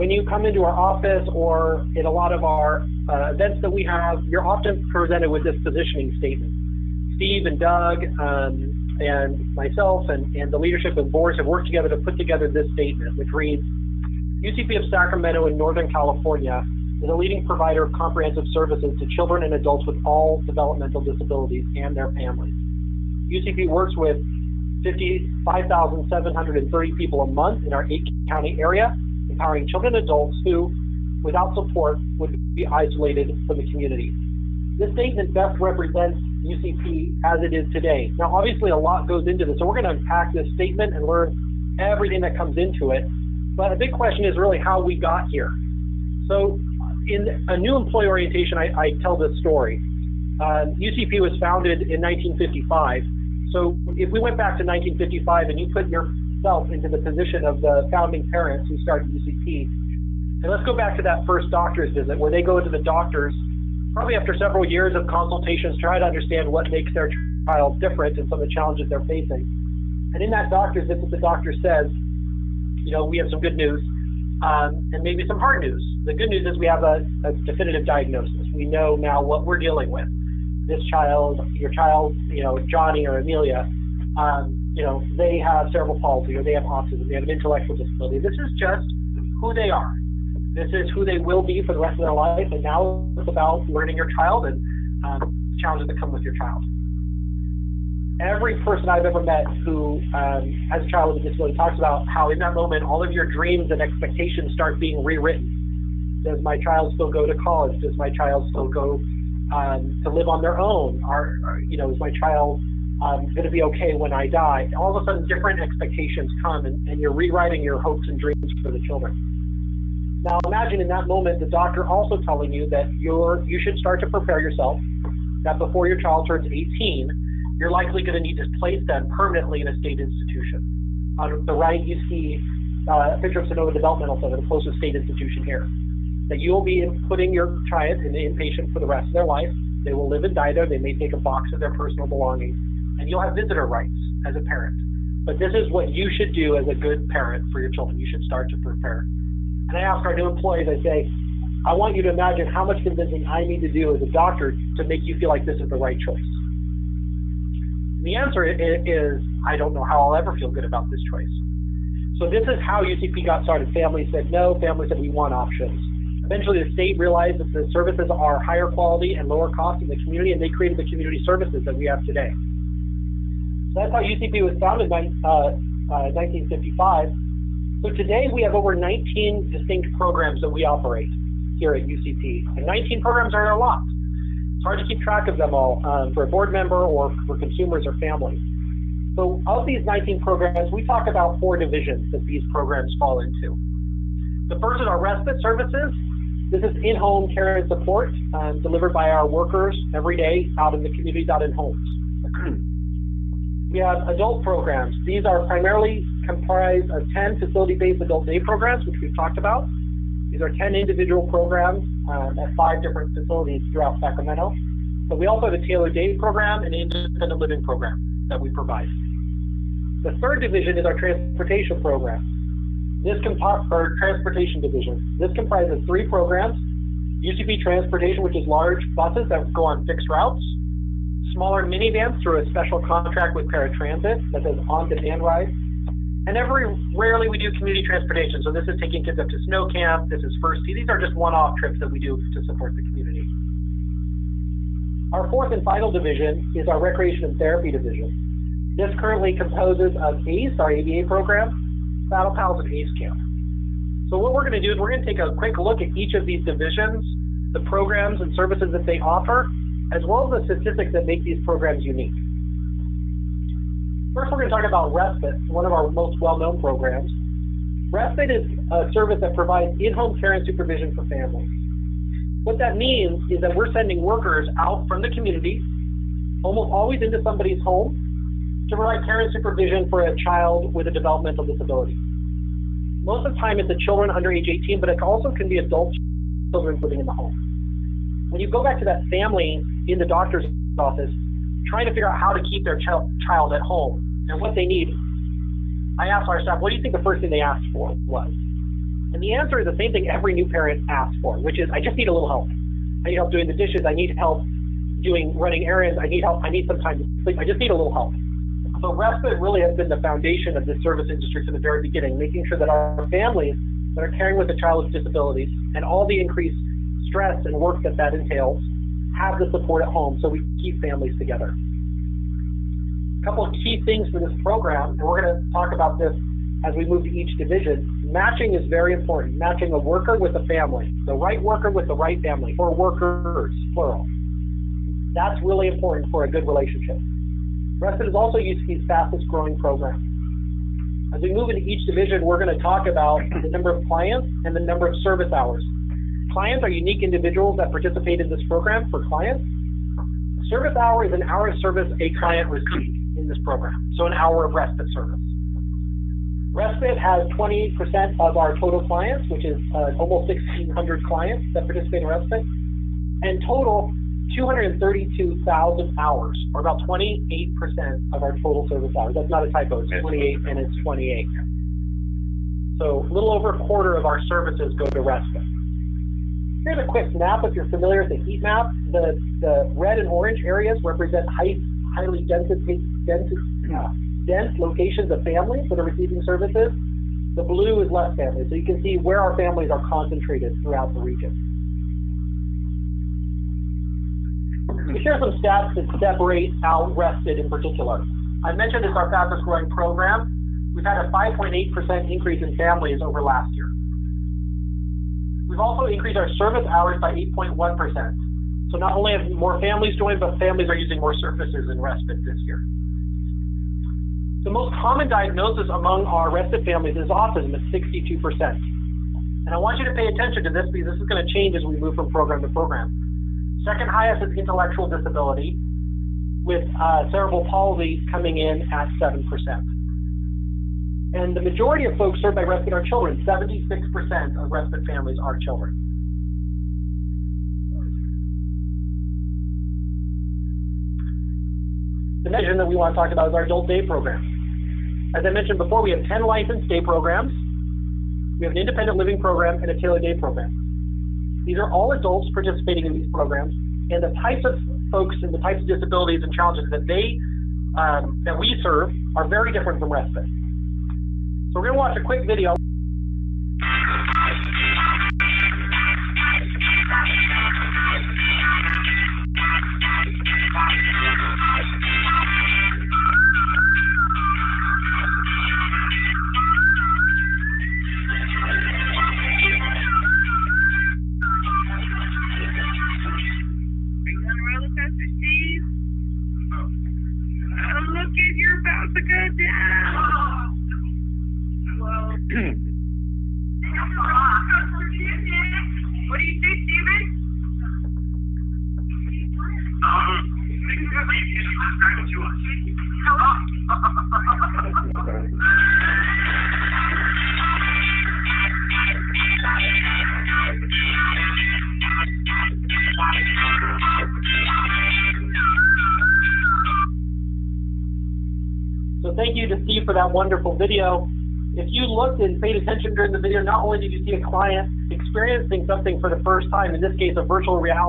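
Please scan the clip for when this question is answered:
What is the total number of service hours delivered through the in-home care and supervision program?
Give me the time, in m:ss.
6:04.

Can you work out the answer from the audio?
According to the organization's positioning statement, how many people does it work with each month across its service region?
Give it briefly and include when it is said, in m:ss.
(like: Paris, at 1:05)
55,730, at 0:24.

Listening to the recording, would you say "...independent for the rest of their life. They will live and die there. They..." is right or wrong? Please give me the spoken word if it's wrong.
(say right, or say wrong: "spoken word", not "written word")
wrong: "inpatient", not "independent".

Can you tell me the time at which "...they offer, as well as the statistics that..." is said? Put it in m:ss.
4:18.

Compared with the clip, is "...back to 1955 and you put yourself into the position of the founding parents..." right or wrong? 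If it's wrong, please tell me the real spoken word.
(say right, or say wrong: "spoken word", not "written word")
right.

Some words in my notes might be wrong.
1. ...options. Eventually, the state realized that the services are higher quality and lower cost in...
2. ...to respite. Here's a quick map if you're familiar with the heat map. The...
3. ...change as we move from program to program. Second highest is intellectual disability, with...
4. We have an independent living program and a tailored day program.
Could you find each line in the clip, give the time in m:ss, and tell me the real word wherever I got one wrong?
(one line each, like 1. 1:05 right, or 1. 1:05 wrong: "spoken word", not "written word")
1. 2:45 right
2. 6:14 right
3. 7:01 right
4. 7:28 right.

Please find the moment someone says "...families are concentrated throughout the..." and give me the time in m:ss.
6:29.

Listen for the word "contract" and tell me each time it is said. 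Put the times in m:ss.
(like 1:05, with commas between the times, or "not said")
3:52.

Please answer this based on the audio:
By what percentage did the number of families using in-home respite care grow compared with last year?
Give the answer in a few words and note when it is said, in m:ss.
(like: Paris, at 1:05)
5.8%, at 6:41.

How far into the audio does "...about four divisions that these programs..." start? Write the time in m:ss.
3:11.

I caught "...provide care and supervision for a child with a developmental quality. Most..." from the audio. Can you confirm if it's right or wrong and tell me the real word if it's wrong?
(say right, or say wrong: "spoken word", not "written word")
wrong: "disability", not "quality".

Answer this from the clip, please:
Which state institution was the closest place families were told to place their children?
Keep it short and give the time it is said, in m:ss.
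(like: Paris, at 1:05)
Sonoma Developmental Center, at 2:13.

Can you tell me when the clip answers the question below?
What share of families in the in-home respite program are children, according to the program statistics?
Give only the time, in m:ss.
7:13.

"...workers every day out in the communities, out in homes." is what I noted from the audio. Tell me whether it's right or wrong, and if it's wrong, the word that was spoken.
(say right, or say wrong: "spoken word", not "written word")
right.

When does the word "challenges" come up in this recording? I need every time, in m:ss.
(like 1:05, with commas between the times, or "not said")
1:08, 1:35, 7:36.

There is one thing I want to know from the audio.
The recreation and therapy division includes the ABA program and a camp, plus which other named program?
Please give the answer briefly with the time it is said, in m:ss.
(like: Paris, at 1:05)
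Saddle Pals, at 4:12.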